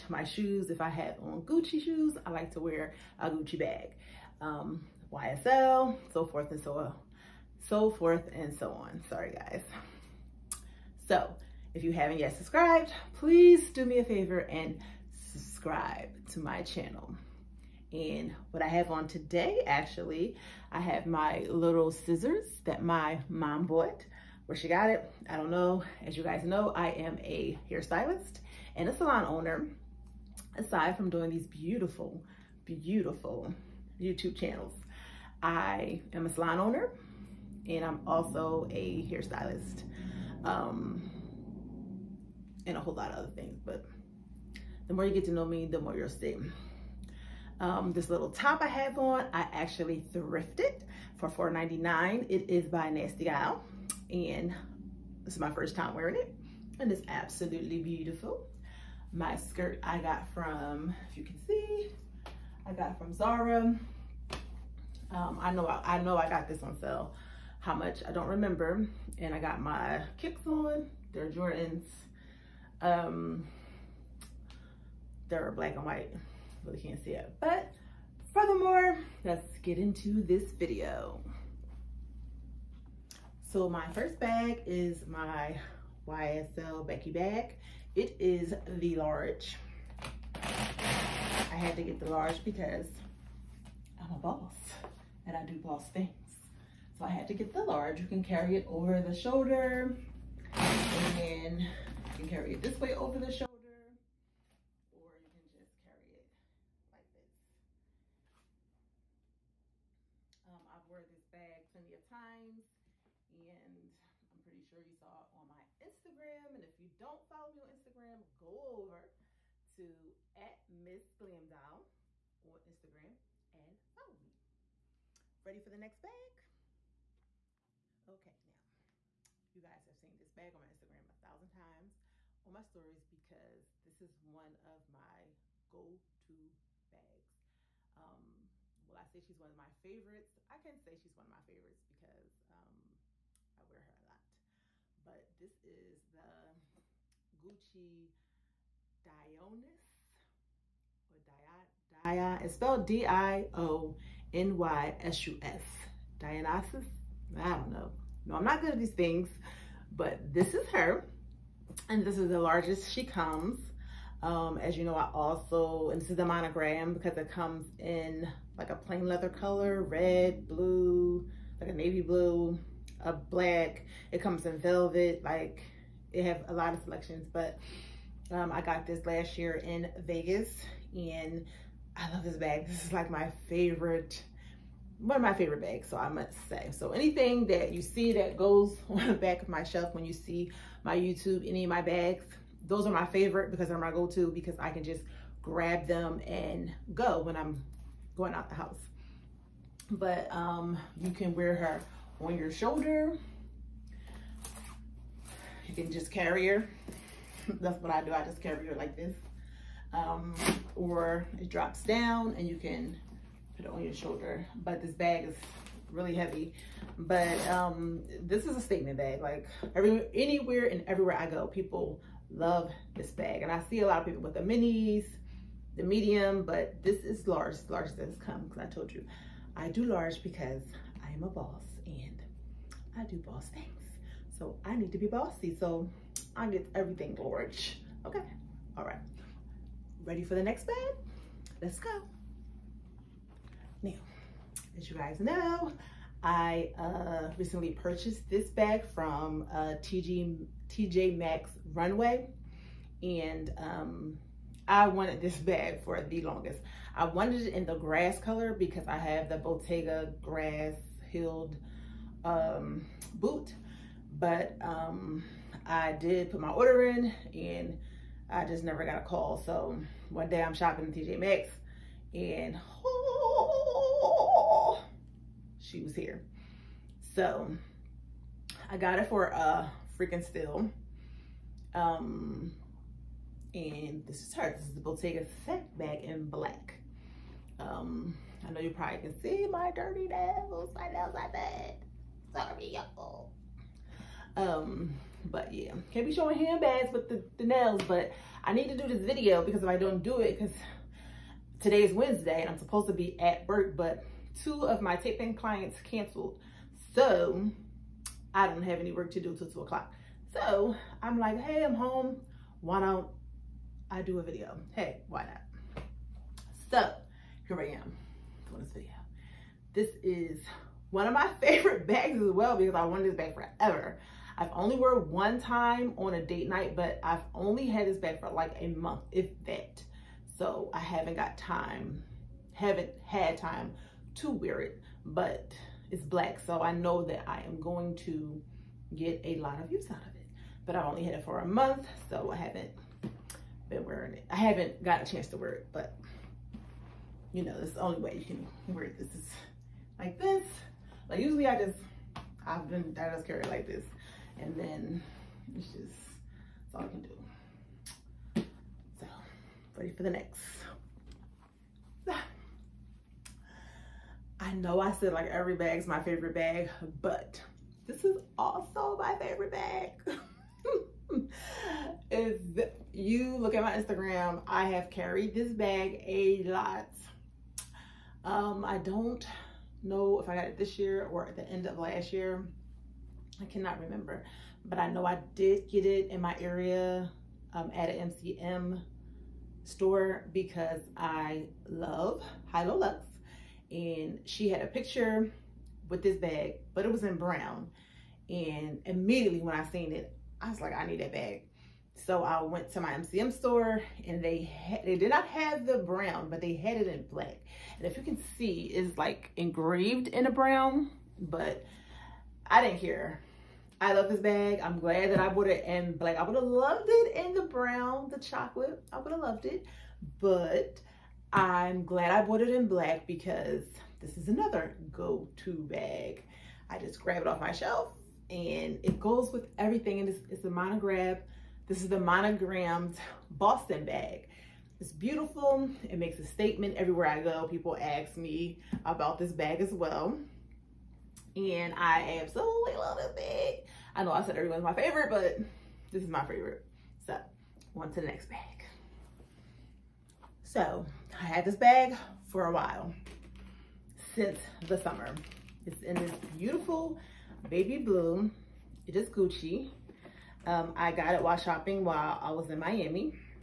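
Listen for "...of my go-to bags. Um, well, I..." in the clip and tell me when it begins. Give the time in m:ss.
2:14.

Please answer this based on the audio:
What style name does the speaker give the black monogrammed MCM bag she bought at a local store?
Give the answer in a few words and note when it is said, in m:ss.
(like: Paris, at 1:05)
Boston bag, at 7:13.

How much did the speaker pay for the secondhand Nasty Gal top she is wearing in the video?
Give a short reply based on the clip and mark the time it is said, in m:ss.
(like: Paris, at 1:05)
$4.99, at 0:51.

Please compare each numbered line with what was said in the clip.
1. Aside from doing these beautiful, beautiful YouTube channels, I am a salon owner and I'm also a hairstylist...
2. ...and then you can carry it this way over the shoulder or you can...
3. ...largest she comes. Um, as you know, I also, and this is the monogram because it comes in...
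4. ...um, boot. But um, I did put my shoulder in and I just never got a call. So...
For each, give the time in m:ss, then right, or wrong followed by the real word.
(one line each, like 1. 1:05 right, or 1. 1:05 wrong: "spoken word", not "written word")
1. 0:30 right
2. 1:40 right
3. 2:42 right
4. 4:22 wrong: "order", not "shoulder".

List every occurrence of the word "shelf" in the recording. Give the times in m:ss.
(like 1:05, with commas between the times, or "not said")
3:09, 7:07.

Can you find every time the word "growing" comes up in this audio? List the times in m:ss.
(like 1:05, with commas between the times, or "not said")
not said.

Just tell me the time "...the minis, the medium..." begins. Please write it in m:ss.
3:44.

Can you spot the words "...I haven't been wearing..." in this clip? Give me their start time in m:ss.
5:42.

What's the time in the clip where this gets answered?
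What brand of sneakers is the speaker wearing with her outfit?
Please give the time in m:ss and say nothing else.
1:11.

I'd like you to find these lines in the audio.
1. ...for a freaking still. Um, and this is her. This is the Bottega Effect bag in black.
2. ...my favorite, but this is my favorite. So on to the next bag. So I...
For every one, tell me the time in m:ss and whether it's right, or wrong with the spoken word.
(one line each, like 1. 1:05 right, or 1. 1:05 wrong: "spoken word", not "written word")
1. 4:39 right
2. 7:24 right.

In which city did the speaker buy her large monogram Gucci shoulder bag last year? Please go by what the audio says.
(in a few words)
Vegas.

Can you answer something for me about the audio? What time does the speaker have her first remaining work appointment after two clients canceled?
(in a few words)
2 o'clock.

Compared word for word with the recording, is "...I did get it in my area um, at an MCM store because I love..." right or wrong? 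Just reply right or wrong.
right.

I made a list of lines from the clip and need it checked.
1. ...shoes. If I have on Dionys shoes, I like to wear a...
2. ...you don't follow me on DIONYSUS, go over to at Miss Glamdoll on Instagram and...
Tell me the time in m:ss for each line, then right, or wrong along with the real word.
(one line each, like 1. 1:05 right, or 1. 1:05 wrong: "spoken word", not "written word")
1. 0:00 wrong: "Gucci", not "Dionys"
2. 1:56 wrong: "Instagram", not "DIONYSUS".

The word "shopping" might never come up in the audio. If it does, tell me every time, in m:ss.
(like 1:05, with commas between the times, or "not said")
4:30, 7:41.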